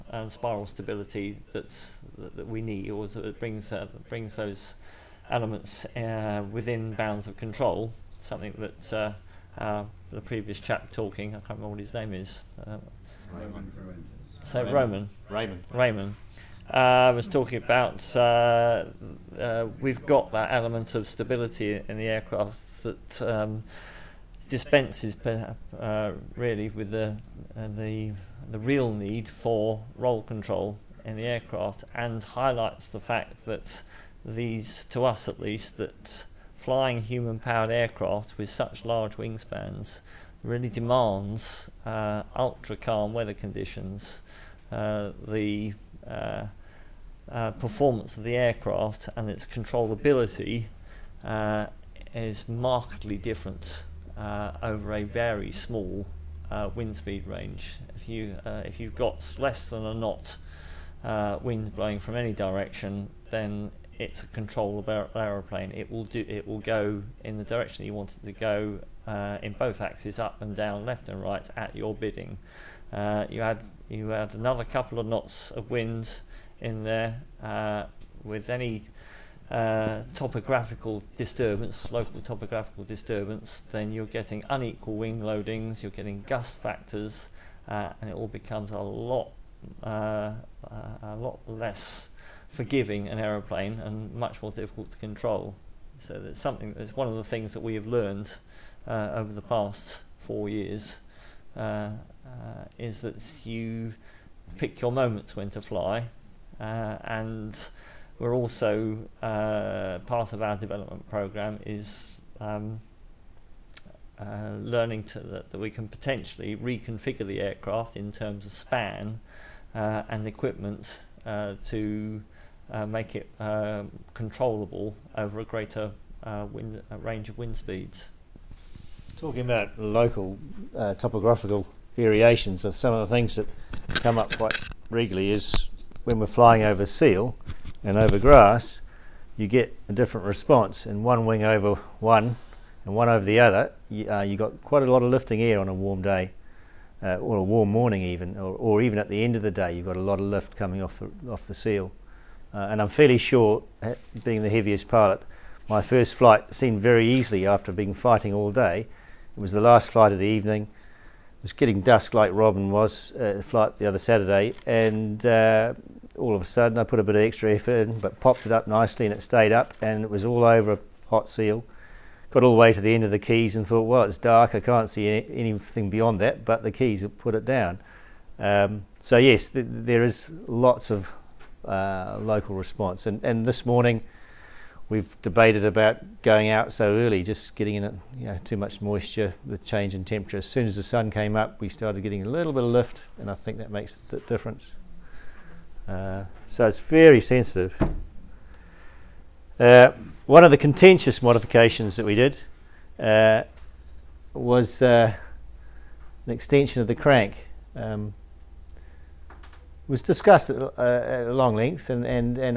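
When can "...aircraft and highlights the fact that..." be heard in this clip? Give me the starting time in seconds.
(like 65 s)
31 s.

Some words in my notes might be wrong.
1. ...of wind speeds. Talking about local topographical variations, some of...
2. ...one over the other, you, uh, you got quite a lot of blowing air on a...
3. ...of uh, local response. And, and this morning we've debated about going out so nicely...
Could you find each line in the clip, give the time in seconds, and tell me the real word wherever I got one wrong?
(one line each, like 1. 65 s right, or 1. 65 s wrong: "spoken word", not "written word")
1. 127 s right
2. 142 s wrong: "lifting", not "blowing"
3. 180 s wrong: "early", not "nicely".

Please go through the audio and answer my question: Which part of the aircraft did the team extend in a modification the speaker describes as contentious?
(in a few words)
the crank.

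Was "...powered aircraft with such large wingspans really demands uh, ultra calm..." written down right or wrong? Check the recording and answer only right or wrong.
right.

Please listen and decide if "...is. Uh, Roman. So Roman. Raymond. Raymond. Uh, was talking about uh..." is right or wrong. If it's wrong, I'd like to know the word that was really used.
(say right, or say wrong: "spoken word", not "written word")
right.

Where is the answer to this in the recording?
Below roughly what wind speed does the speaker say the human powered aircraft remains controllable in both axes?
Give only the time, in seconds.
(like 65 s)
59 s.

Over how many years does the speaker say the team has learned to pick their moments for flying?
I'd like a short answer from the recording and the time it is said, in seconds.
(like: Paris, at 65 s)
4, at 100 s.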